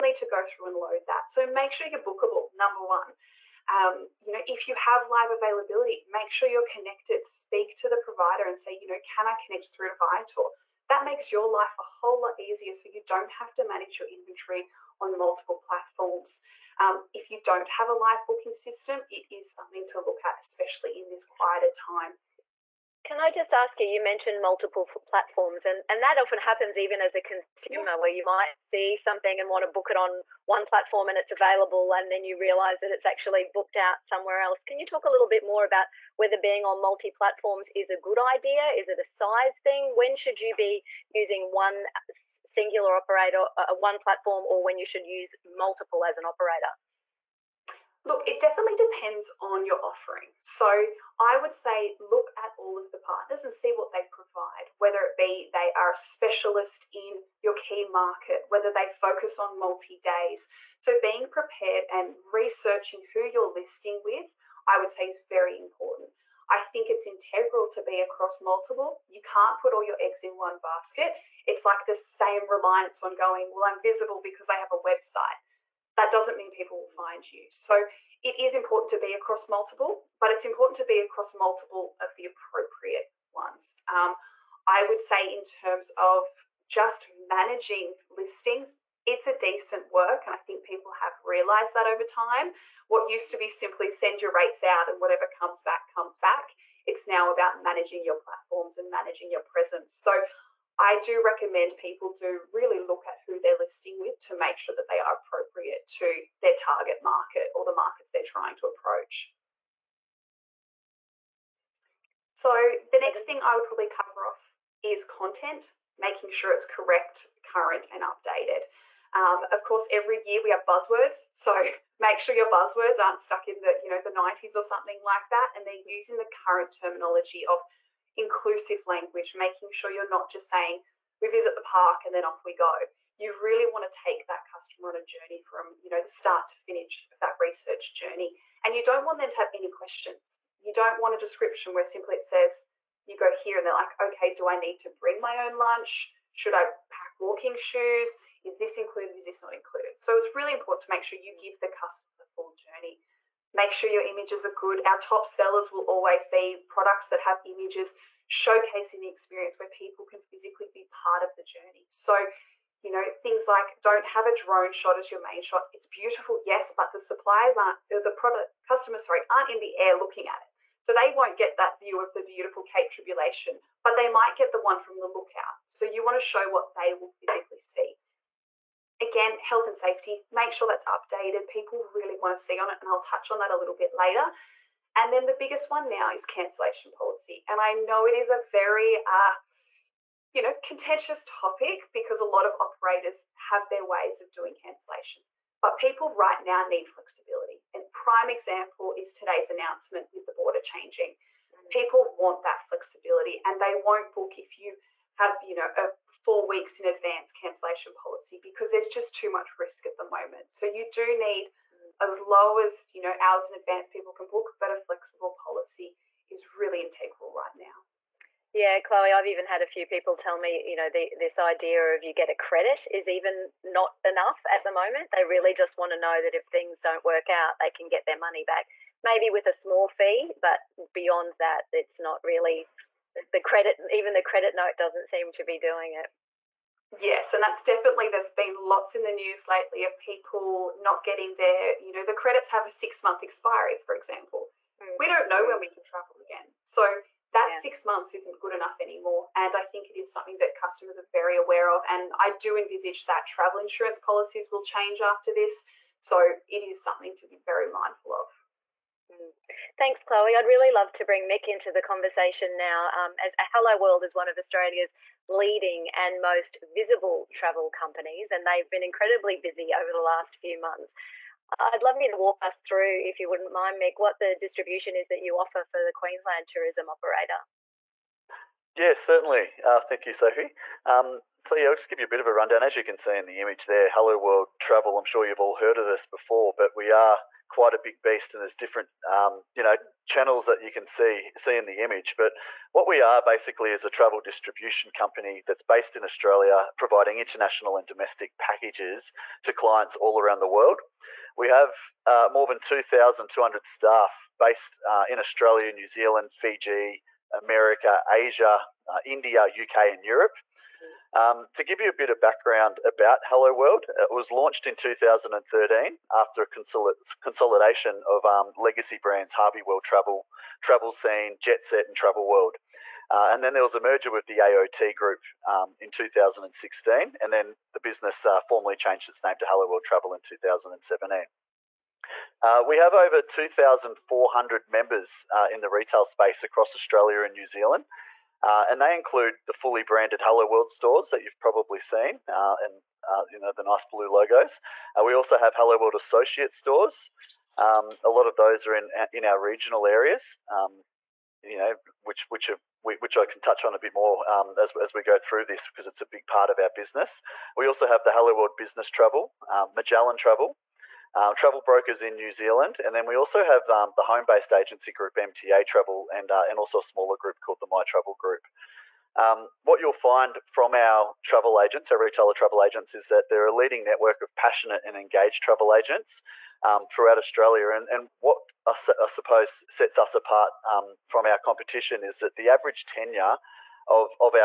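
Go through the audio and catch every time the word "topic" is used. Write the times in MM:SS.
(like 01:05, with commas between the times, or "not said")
03:11.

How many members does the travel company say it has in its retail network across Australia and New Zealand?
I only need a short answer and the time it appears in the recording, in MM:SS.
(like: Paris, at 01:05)
Over 2,400, at 05:32.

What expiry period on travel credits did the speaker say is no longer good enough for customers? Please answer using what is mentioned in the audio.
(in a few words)
6 months.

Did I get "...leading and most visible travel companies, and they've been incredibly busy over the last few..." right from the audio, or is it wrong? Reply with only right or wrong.
right.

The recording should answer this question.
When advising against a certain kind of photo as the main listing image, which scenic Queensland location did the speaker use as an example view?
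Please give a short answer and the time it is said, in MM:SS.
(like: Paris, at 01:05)
Cape Tribulation, at 02:52.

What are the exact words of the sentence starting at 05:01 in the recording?
We have uh, more than 2,200 staff based uh, in Australia, New Zealand, Fiji, America, Asia, uh, India, UK, and Europe.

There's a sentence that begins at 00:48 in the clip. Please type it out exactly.
Look, it definitely depends on your offering.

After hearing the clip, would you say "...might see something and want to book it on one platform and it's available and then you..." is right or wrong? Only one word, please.
right.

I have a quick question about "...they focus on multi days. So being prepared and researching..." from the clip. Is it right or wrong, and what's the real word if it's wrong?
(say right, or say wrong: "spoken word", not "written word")
right.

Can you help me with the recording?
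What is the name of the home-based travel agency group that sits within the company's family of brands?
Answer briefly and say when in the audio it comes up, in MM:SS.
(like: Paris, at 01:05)
MTA Travel, at 06:05.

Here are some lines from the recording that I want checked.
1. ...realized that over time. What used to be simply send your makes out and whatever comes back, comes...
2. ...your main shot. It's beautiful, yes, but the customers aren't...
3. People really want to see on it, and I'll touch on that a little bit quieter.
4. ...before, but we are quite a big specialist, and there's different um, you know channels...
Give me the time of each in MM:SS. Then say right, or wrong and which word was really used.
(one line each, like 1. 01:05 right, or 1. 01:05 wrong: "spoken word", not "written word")
1. 01:31 wrong: "rates", not "makes"
2. 02:45 wrong: "suppliers", not "customers"
3. 03:01 wrong: "later", not "quieter"
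4. 04:46 wrong: "beast", not "specialist".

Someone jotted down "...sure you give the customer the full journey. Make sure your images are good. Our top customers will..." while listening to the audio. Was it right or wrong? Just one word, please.
wrong.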